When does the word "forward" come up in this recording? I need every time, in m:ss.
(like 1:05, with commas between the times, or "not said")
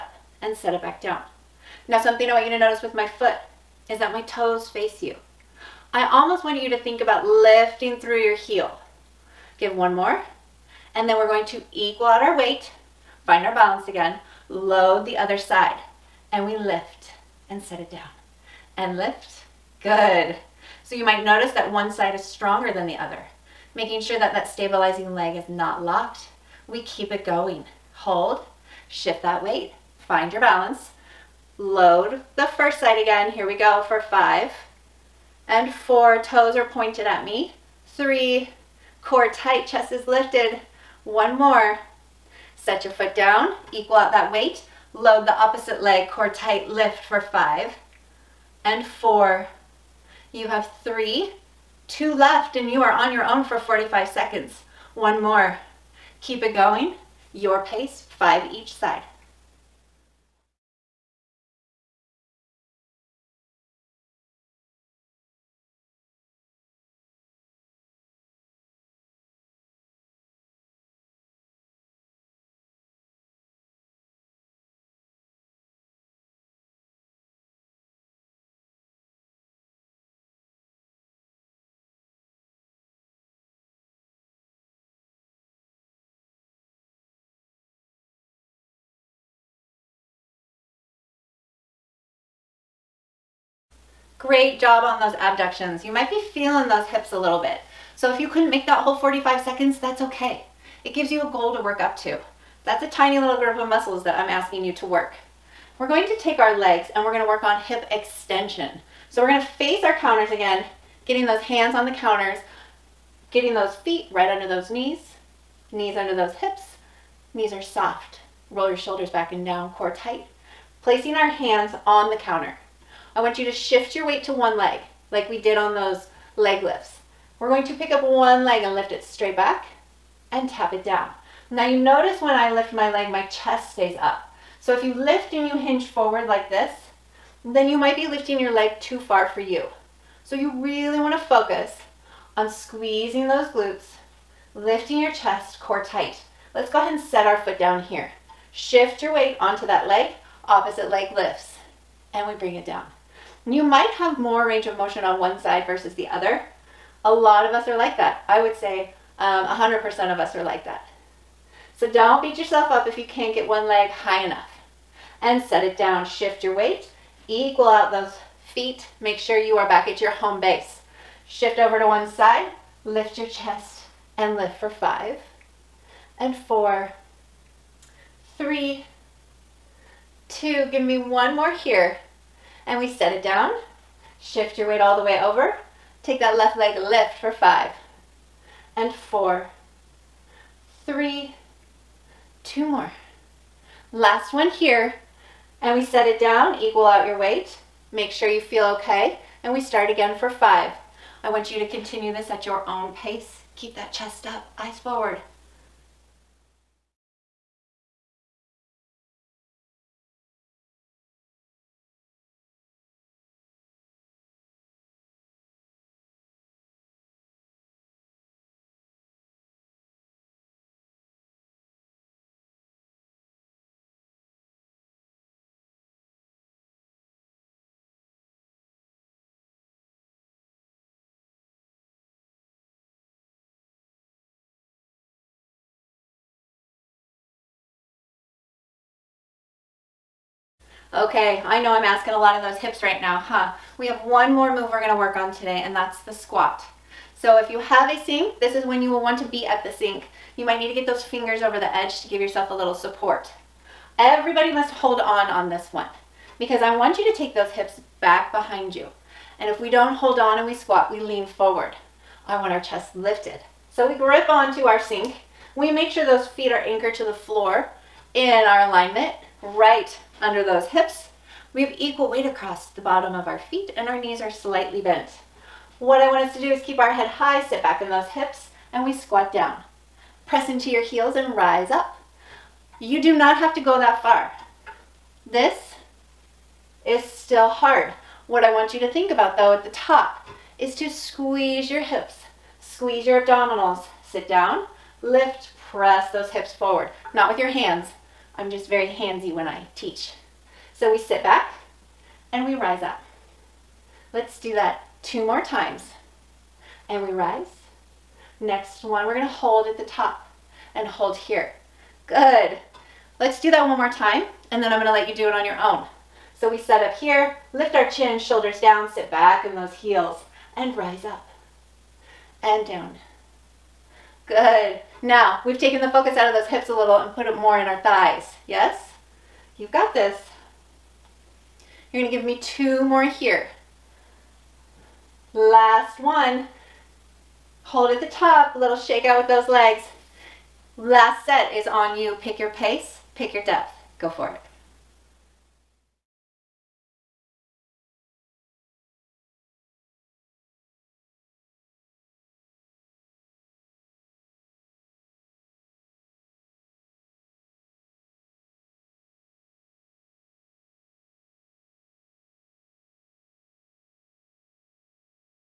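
2:15, 3:24, 4:21, 4:56.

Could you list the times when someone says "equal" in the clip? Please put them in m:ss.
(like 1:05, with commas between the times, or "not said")
0:11, 0:43, 2:47, 3:16, 4:31.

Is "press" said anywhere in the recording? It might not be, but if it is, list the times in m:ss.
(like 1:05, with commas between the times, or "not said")
4:40, 4:55.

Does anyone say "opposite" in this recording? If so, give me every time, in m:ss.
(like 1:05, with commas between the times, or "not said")
0:45, 2:30.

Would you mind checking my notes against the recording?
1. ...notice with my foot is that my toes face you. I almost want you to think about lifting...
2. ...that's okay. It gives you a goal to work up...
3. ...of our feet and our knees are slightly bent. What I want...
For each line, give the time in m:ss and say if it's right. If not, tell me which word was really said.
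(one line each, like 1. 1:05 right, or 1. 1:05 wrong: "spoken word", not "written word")
1. 0:02 right
2. 1:39 right
3. 4:33 right.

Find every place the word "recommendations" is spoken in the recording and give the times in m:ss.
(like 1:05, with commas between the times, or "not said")
not said.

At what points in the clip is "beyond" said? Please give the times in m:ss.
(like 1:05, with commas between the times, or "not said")
not said.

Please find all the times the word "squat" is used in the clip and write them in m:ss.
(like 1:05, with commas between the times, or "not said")
4:06, 4:20, 4:38.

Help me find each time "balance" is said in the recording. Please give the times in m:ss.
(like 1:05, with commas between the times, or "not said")
0:13, 0:30.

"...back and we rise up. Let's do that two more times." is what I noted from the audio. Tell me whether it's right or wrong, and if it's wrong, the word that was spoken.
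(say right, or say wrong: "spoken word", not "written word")
right.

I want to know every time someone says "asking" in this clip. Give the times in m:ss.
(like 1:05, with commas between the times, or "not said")
1:44, 4:01.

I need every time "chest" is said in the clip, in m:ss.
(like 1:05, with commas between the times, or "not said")
0:39, 2:13, 2:25, 2:53, 3:23, 4:22.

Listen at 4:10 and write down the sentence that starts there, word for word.
You might need to get those fingers over the edge to give yourself a little support.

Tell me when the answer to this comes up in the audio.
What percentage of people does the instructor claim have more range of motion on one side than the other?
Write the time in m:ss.
2:39.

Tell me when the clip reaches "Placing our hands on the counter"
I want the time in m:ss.
2:00.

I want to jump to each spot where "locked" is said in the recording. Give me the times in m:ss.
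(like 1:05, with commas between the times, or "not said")
0:25.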